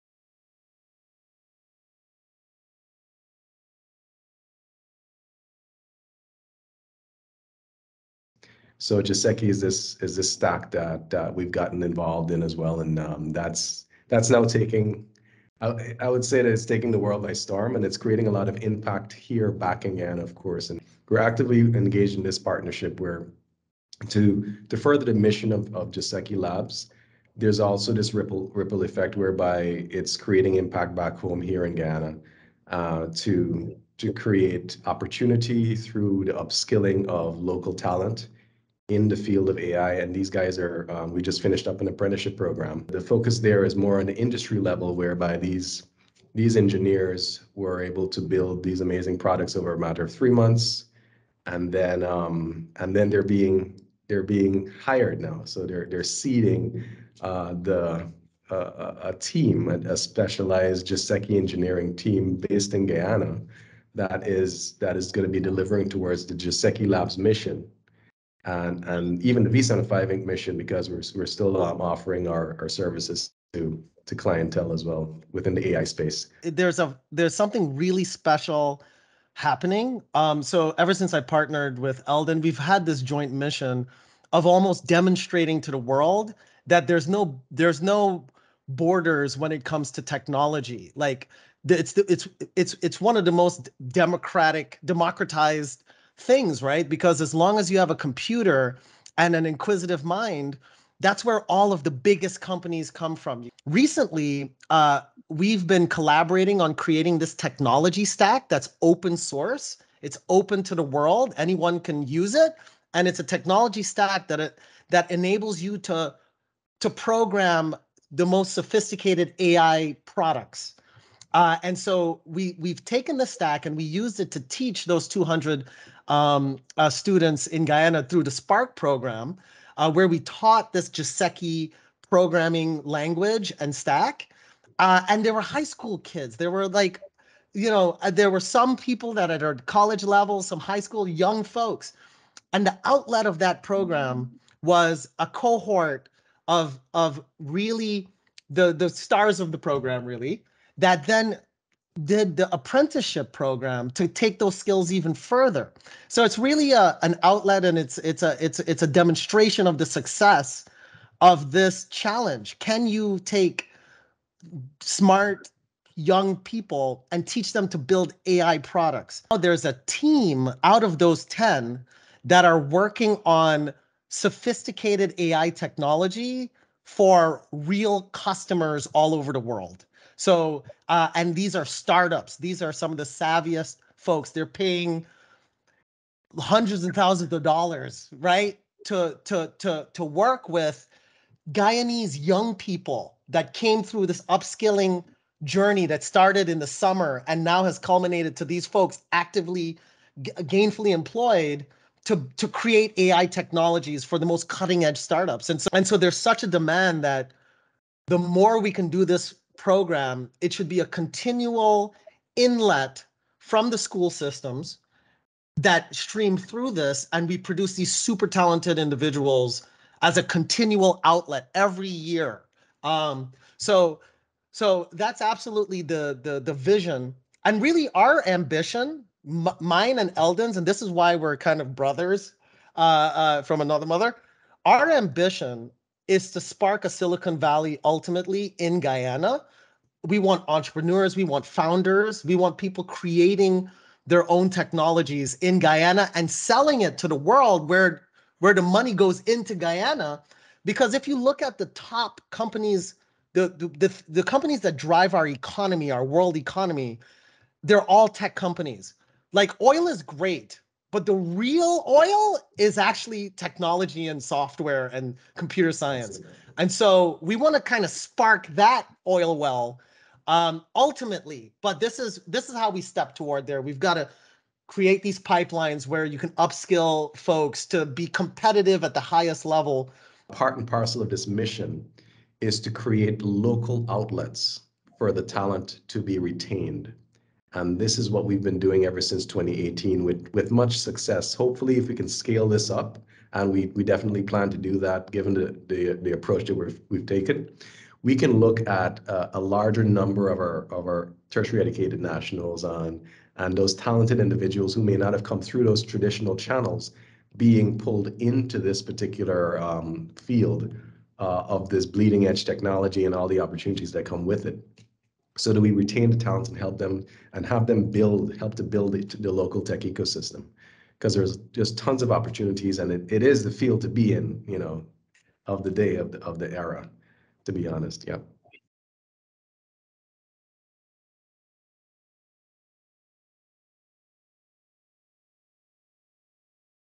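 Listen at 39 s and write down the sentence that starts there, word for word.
And these guys are, um, we just finished up an apprenticeship program.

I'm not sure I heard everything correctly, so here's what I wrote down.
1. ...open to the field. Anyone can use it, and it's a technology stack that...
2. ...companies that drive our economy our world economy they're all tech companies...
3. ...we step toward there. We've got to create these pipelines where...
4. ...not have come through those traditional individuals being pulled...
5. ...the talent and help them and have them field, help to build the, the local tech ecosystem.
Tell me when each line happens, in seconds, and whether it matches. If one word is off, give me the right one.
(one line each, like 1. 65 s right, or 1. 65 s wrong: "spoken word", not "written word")
1. 110 s wrong: "world", not "field"
2. 254 s right
3. 272 s right
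4. 304 s wrong: "channels", not "individuals"
5. 316 s wrong: "build", not "field".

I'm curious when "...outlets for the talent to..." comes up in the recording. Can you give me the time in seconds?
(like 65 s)
283 s.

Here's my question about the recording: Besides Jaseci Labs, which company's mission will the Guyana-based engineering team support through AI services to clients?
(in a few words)
V75 Inc.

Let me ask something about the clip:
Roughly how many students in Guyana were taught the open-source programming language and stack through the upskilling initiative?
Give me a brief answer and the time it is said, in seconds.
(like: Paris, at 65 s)
200, at 125 s.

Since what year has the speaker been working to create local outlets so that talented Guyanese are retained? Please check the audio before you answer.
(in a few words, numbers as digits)
2018.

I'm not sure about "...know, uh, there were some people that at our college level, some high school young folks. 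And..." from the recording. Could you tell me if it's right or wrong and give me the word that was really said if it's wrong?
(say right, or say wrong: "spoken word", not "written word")
right.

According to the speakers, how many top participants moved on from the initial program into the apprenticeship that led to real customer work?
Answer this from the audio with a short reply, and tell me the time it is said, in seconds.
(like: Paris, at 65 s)
10, at 171 s.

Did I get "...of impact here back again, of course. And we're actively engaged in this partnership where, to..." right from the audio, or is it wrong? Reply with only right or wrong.
right.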